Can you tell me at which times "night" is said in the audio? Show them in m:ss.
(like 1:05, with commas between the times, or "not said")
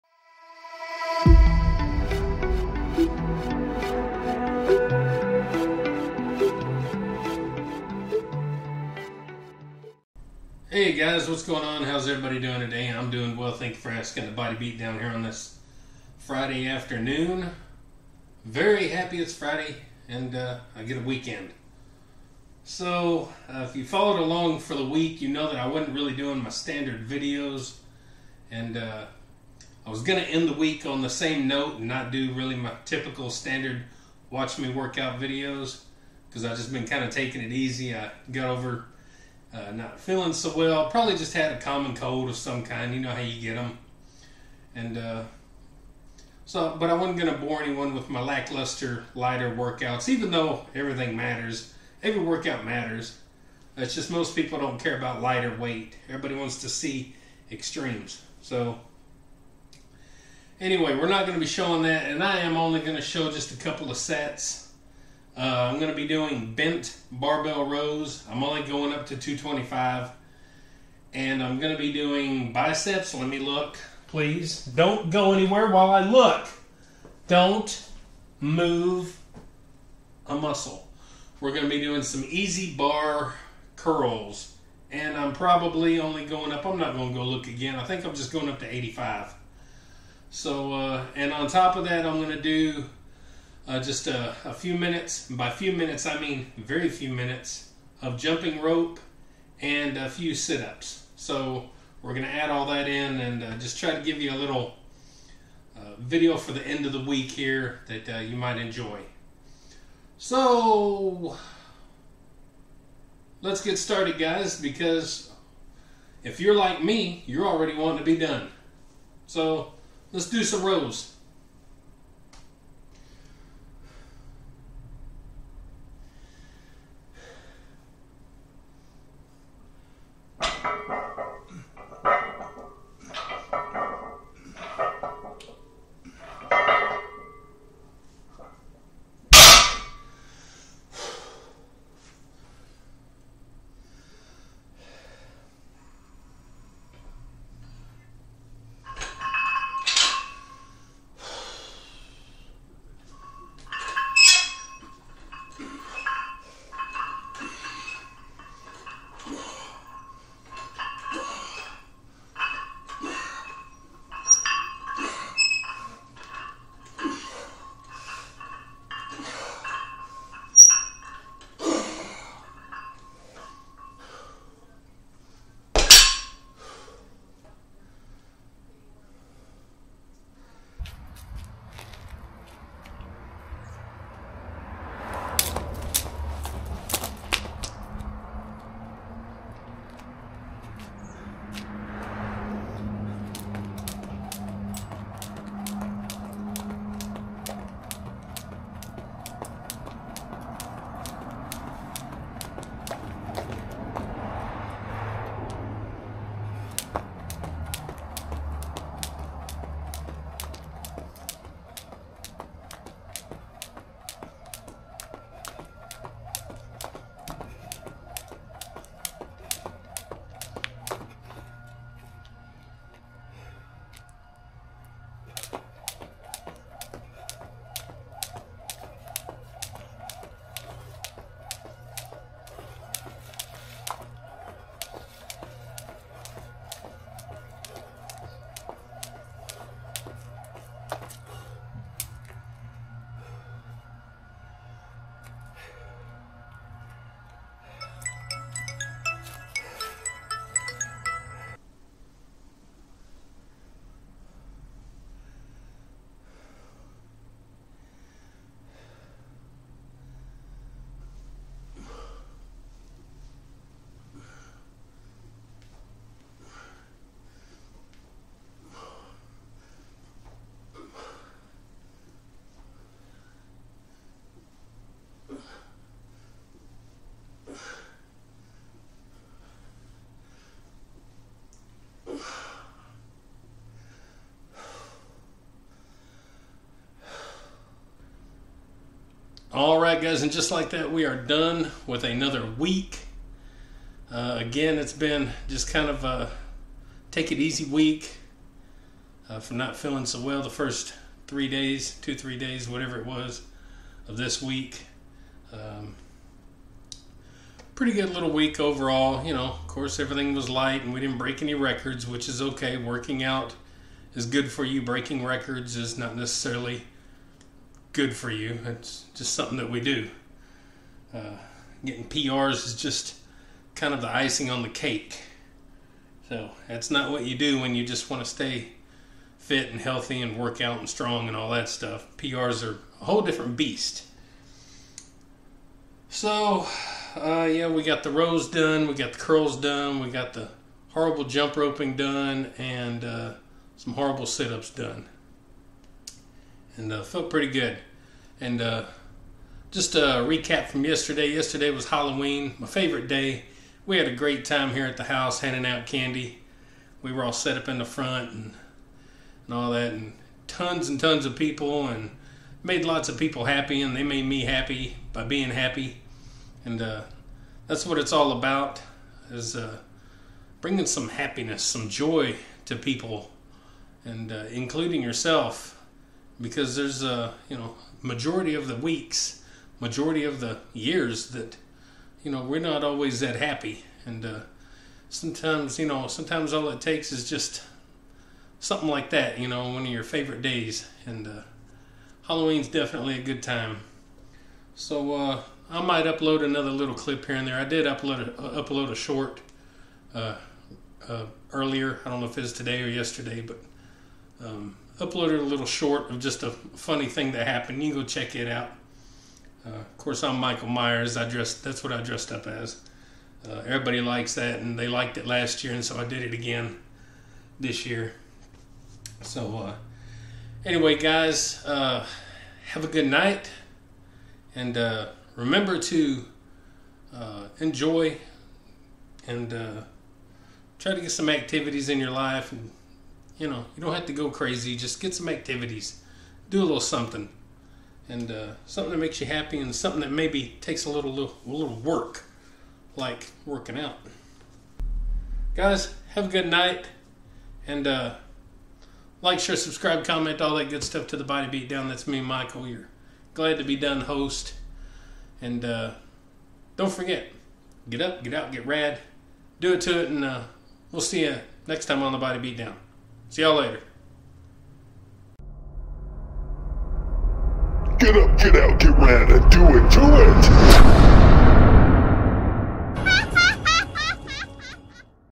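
7:03, 7:26.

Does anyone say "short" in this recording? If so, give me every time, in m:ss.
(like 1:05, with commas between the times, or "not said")
6:38, 6:45.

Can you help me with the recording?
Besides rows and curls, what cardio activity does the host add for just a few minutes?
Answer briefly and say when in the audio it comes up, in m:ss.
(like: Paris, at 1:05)
jumping rope, at 1:38.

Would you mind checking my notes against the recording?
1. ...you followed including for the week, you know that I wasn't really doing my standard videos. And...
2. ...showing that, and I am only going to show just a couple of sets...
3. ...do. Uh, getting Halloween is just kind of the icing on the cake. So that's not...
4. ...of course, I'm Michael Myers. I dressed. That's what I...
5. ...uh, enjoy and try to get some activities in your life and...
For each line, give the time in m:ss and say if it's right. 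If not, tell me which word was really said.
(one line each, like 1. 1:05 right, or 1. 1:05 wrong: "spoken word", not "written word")
1. 0:23 wrong: "along", not "including"
2. 1:01 right
3. 5:19 wrong: "PRs", not "Halloween"
4. 6:49 right
5. 7:07 right.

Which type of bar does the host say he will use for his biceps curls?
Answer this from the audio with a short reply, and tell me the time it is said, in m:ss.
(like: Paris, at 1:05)
EZ bar, at 1:22.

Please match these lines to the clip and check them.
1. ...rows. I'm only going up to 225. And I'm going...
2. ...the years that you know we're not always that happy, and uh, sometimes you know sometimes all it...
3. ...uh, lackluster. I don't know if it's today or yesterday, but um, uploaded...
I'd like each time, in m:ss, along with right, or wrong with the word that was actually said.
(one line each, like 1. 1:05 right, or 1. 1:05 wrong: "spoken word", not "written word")
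1. 1:07 right
2. 6:20 right
3. 6:41 wrong: "earlier", not "lackluster".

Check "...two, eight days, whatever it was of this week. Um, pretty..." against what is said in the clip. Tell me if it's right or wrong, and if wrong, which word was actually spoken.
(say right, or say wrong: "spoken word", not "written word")
wrong: "three", not "eight".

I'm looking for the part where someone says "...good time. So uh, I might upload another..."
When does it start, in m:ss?
6:33.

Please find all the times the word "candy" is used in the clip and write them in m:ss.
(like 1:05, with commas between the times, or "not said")
5:55.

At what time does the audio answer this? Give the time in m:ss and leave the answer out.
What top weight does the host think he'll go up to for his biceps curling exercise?
1:28.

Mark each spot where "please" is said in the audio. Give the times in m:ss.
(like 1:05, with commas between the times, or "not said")
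1:14.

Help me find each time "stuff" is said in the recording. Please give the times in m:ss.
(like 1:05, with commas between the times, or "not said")
5:31, 7:30.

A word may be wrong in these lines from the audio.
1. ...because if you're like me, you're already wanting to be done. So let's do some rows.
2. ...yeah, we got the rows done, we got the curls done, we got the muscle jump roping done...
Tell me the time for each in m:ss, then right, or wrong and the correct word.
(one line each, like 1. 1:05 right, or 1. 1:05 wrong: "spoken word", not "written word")
1. 1:54 right
2. 5:37 wrong: "horrible", not "muscle".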